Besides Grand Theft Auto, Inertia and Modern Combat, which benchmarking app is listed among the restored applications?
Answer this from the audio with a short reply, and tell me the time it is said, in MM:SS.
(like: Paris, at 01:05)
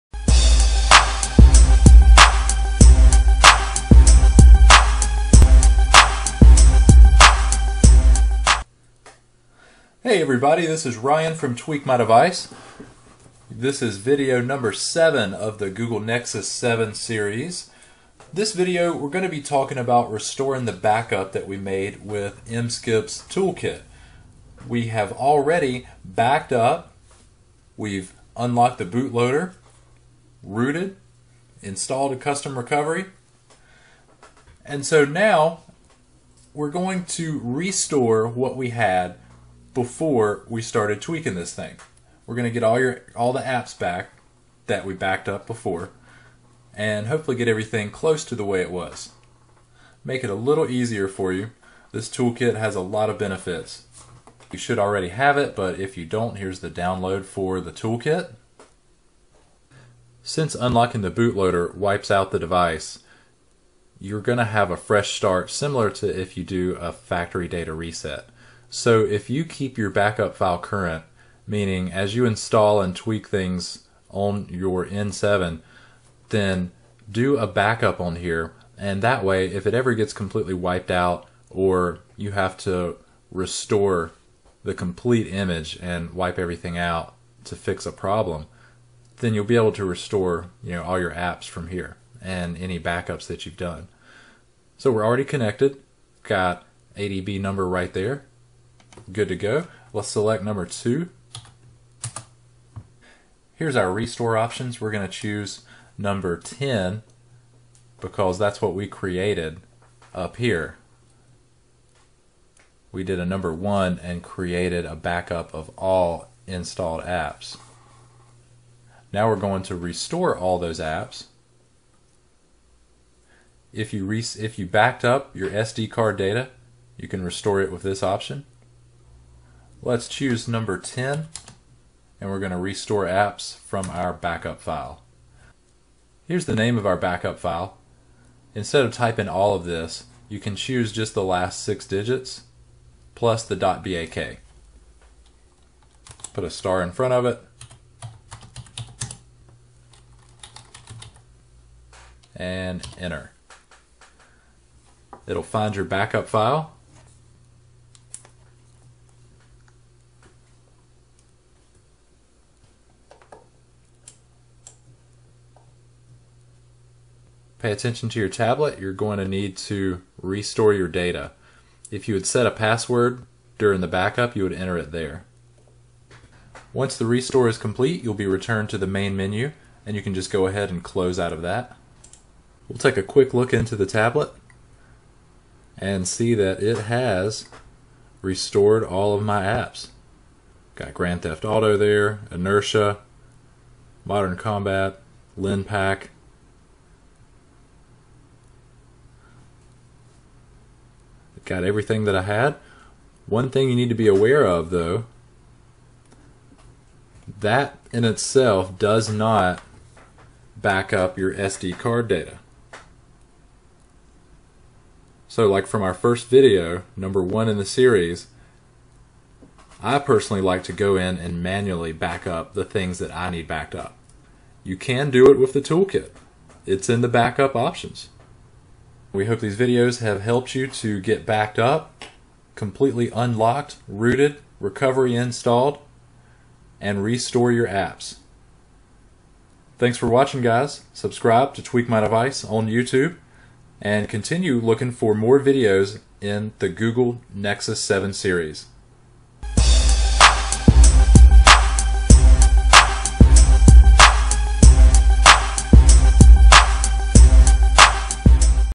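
Linpack, at 03:15.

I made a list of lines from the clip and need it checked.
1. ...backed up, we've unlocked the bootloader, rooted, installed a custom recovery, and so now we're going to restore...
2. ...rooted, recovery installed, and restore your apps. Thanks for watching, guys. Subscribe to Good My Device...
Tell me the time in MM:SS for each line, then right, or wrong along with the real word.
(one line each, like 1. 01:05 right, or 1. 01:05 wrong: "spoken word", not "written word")
1. 00:26 right
2. 03:53 wrong: "Tweak", not "Good".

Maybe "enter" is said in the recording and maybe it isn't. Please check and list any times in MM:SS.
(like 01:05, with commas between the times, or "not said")
02:32, 02:54.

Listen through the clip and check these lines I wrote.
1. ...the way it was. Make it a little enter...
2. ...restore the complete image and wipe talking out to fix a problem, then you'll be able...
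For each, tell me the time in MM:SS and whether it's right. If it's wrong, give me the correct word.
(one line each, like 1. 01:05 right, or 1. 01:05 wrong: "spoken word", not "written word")
1. 00:48 wrong: "easier", not "enter"
2. 01:23 wrong: "everything", not "talking".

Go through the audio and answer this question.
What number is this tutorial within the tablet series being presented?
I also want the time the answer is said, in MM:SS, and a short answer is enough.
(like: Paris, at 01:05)
7, at 00:13.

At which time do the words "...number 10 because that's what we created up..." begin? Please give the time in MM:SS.
01:45.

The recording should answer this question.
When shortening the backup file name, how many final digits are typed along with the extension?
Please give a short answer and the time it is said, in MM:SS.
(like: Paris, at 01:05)
6, at 02:21.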